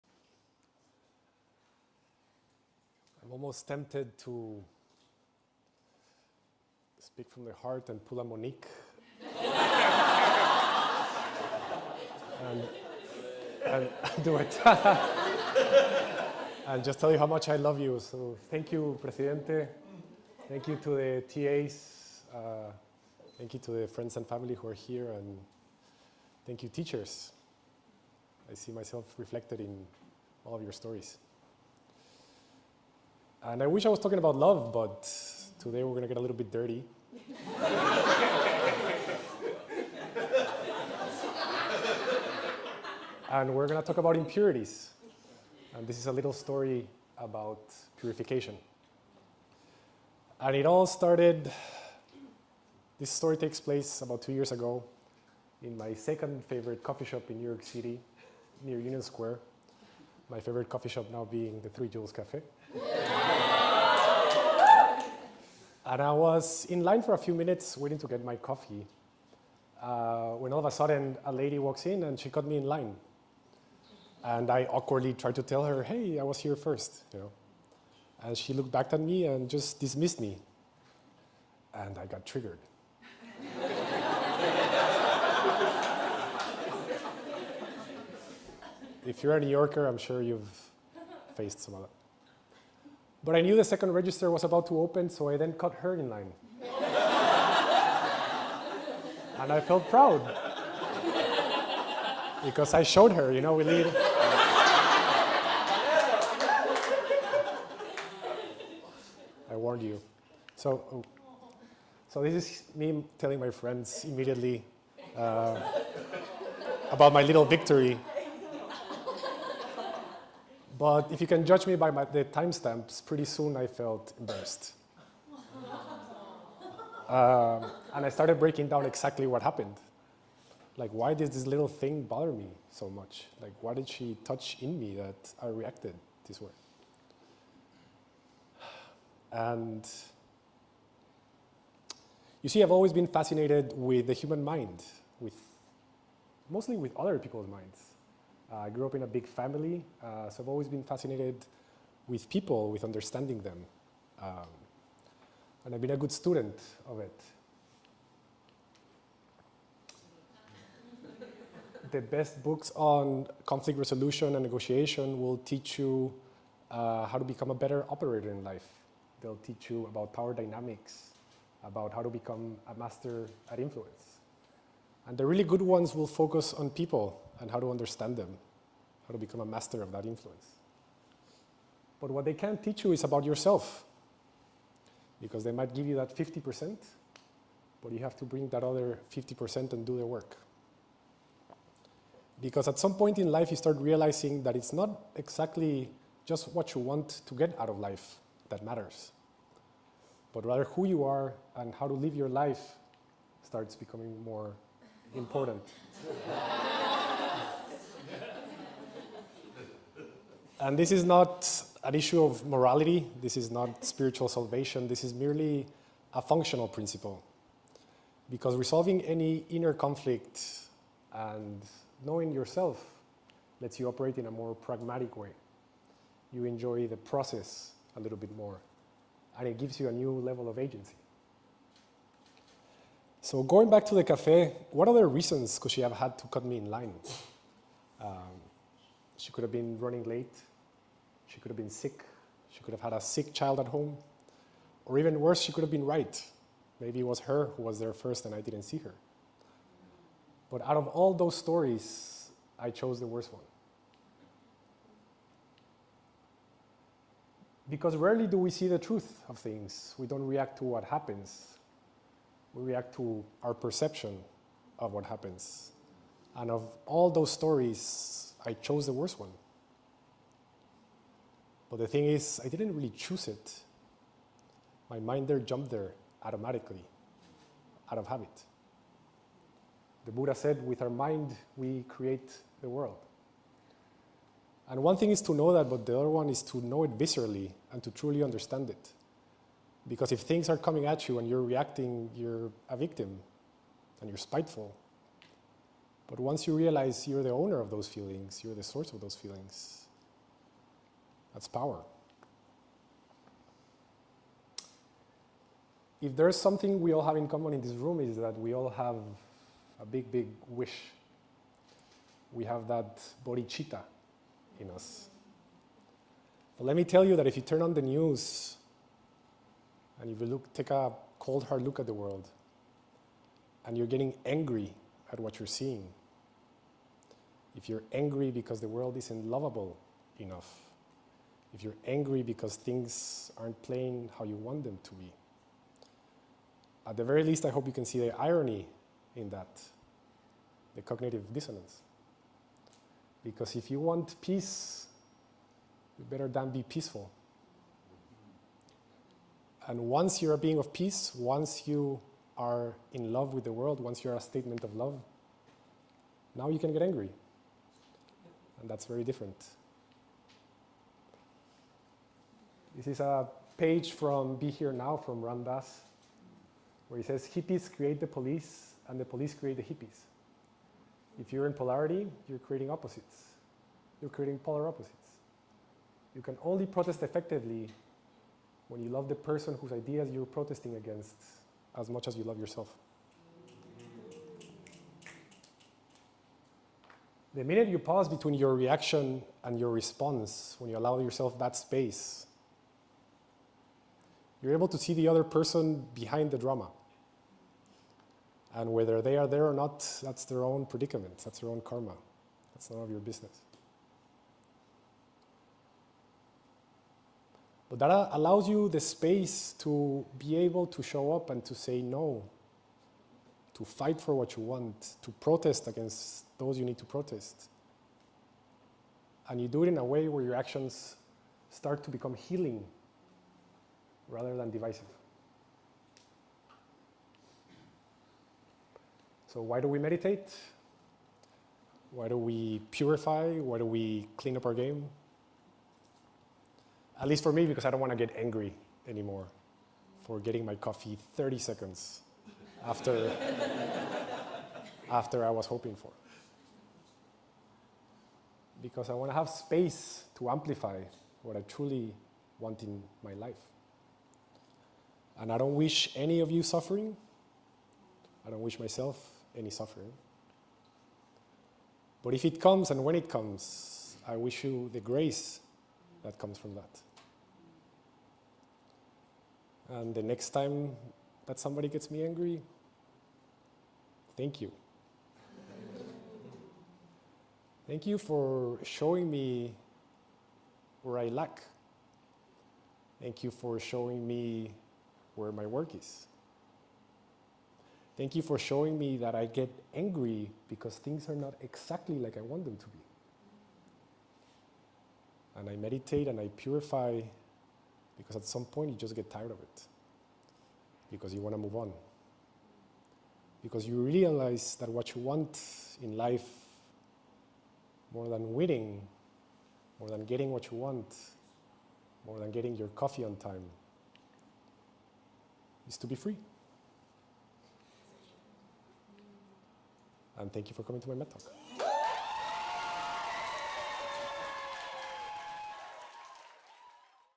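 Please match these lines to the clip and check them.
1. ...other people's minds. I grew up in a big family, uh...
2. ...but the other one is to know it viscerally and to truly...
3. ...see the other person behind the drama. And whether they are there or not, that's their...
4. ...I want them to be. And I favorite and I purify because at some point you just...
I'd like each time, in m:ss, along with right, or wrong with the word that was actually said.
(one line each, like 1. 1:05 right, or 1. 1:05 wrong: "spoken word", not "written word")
1. 2:26 right
2. 4:45 right
3. 6:34 right
4. 8:12 wrong: "meditate", not "favorite".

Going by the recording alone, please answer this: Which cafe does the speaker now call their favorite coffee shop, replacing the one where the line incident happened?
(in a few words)
Three Jewels Cafe.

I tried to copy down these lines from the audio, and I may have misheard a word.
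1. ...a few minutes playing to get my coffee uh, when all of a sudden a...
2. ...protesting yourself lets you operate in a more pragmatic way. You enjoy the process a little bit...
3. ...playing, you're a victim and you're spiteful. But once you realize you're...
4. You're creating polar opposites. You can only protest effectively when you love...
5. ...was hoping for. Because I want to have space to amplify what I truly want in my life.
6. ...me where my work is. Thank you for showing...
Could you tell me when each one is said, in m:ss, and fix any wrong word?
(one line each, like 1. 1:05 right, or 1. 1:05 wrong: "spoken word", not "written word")
1. 1:07 wrong: "waiting", not "playing"
2. 3:42 wrong: "knowing", not "protesting"
3. 4:51 wrong: "reacting", not "playing"
4. 6:14 right
5. 7:25 right
6. 8:04 right.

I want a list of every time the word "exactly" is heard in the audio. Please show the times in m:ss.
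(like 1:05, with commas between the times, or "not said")
2:08, 3:15, 8:11.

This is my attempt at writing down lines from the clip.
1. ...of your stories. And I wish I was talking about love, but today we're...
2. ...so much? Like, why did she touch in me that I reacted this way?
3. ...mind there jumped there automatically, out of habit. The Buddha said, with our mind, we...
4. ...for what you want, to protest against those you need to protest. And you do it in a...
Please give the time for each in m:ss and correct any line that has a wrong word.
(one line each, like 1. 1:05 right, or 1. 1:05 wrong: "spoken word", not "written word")
1. 0:30 right
2. 2:12 right
3. 4:34 right
4. 6:54 right.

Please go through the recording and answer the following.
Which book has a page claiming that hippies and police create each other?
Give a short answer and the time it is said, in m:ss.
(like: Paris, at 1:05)
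Be Here Now, at 6:04.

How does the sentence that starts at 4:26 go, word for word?
And of all those stories, I chose the worst one.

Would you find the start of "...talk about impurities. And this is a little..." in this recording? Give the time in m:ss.
0:43.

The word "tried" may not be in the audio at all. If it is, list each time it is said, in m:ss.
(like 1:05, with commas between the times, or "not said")
1:15.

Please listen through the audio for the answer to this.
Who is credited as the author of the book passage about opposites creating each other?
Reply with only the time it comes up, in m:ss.
6:05.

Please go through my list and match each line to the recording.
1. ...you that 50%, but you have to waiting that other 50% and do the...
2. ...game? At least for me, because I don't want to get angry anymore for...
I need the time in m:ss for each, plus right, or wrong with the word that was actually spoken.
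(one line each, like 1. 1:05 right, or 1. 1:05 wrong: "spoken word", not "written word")
1. 3:05 wrong: "bring", not "waiting"
2. 7:14 right.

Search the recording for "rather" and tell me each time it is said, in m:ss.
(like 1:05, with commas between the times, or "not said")
3:20, 7:04.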